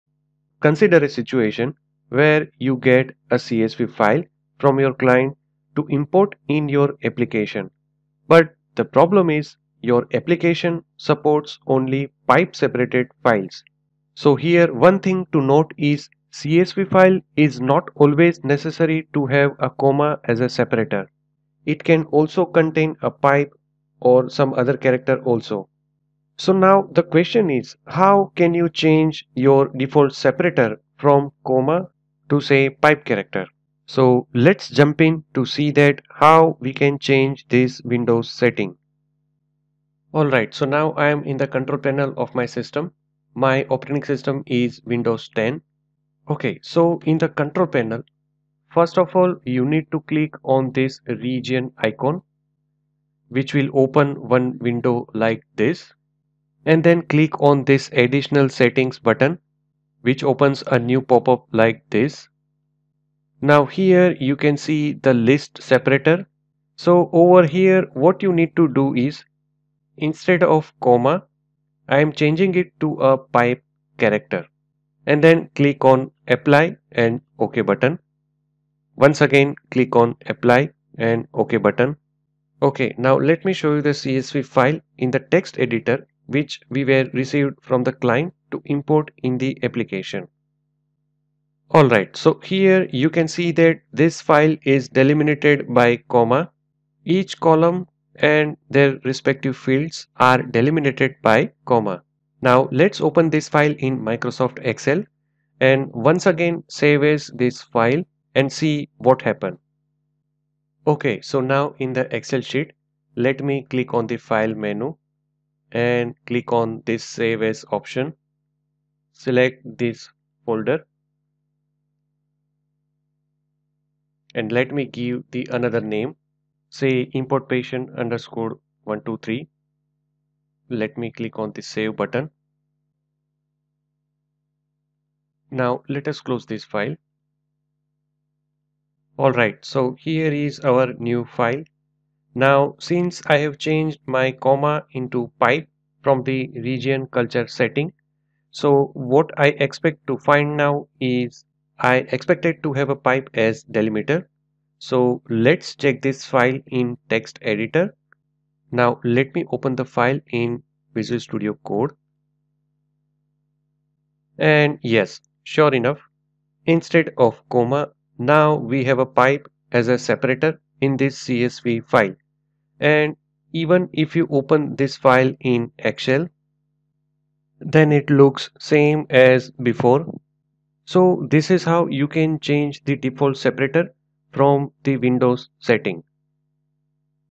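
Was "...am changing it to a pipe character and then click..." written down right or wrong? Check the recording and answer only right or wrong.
right.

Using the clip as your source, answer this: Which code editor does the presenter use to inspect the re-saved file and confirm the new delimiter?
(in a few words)
Visual Studio Code.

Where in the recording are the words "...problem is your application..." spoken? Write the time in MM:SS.
00:08.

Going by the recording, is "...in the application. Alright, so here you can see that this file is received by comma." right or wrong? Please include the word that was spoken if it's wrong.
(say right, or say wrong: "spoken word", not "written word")
wrong: "delimited", not "received".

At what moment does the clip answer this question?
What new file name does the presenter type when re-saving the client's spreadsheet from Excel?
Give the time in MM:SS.
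02:07.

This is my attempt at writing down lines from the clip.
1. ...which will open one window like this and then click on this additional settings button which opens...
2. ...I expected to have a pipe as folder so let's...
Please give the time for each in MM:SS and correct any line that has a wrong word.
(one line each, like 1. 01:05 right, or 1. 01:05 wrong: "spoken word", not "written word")
1. 00:53 right
2. 02:31 wrong: "delimiter", not "folder".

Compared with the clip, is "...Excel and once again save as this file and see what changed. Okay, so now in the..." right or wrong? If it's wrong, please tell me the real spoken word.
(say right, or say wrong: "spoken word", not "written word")
wrong: "happened", not "changed".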